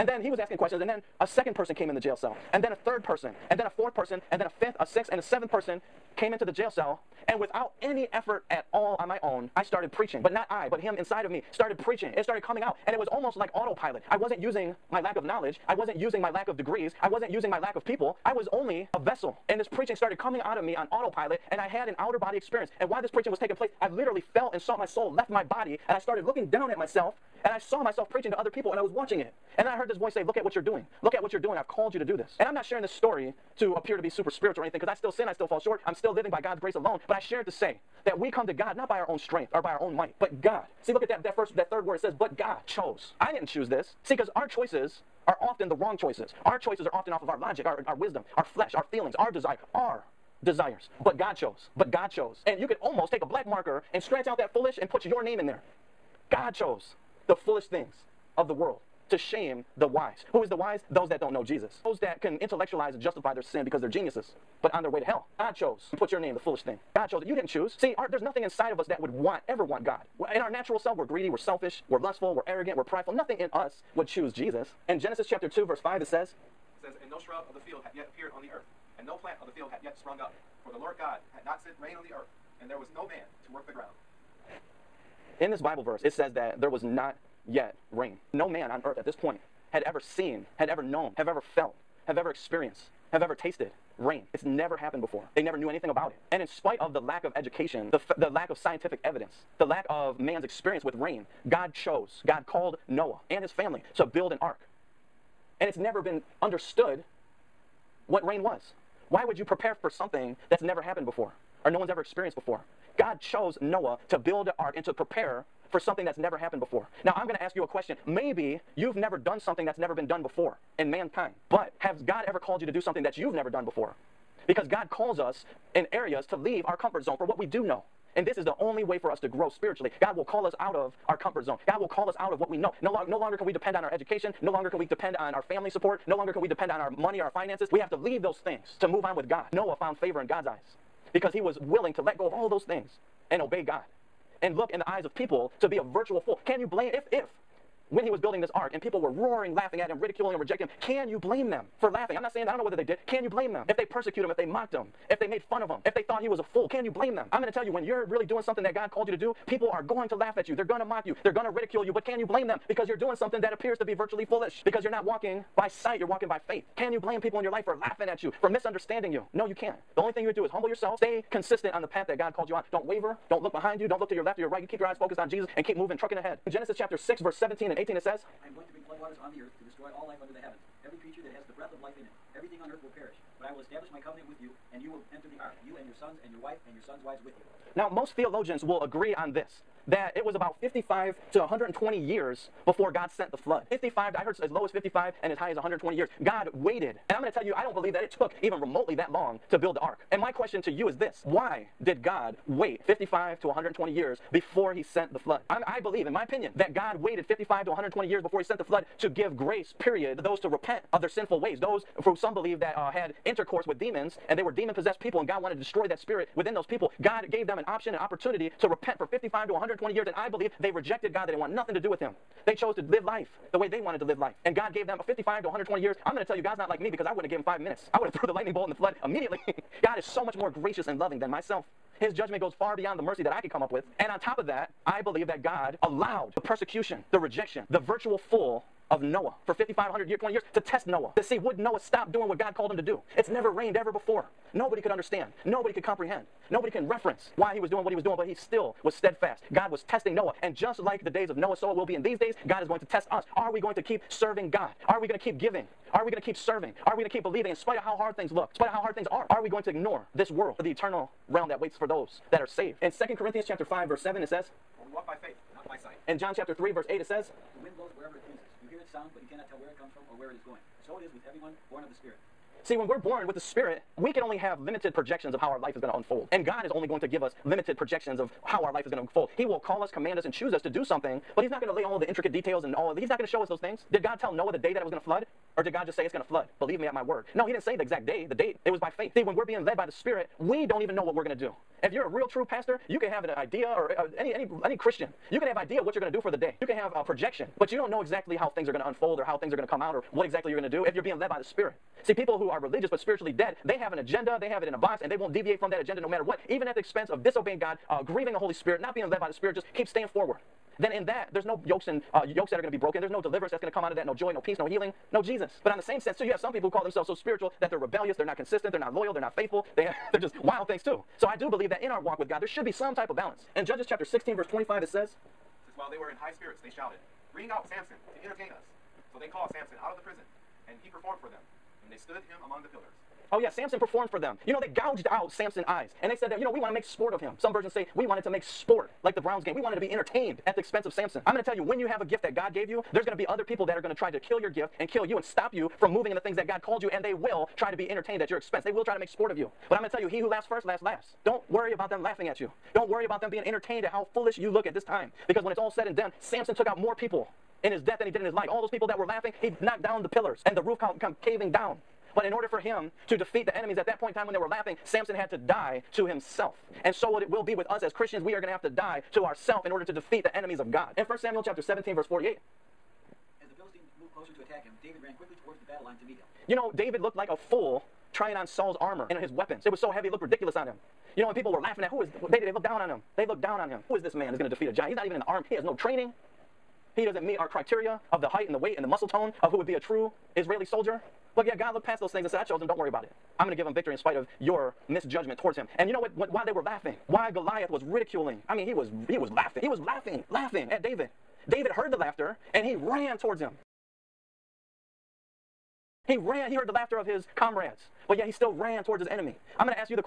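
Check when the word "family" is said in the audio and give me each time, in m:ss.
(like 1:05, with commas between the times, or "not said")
1:43, 2:15.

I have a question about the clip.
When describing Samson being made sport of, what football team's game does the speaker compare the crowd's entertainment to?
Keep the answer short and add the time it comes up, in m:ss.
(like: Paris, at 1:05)
the Browns, at 5:39.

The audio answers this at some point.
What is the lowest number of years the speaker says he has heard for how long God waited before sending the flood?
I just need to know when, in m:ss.
3:14.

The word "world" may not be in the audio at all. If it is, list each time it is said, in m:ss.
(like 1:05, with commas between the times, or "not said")
0:58, 4:20.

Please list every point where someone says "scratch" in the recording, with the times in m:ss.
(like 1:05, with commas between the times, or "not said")
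0:54.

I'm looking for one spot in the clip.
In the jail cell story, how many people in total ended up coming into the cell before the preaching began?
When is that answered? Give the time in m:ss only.
0:05.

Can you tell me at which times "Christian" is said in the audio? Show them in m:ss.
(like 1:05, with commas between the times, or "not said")
4:54, 6:07.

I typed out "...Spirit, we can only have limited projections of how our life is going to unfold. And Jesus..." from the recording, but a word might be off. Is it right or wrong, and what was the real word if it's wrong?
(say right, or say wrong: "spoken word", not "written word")
wrong: "God", not "Jesus".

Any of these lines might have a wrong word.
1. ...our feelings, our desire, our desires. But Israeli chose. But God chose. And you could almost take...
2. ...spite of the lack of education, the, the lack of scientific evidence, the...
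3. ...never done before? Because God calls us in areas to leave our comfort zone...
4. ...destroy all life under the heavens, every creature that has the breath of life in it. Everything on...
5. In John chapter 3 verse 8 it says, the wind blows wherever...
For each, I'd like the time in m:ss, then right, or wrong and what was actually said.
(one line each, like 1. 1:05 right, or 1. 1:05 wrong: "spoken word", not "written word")
1. 0:48 wrong: "God", not "Israeli"
2. 1:36 right
3. 2:03 right
4. 2:59 right
5. 4:26 right.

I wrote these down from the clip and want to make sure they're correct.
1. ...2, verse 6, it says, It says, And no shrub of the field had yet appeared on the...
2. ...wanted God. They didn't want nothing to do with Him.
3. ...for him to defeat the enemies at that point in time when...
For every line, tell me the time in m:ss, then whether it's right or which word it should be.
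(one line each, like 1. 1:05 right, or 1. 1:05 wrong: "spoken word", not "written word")
1. 1:15 wrong: "5", not "6"
2. 3:40 wrong: "rejected", not "wanted"
3. 6:02 right.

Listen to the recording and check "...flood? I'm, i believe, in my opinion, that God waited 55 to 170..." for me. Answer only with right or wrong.
wrong.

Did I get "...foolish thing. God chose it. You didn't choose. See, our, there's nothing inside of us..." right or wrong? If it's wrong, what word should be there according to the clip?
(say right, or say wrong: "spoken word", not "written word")
right.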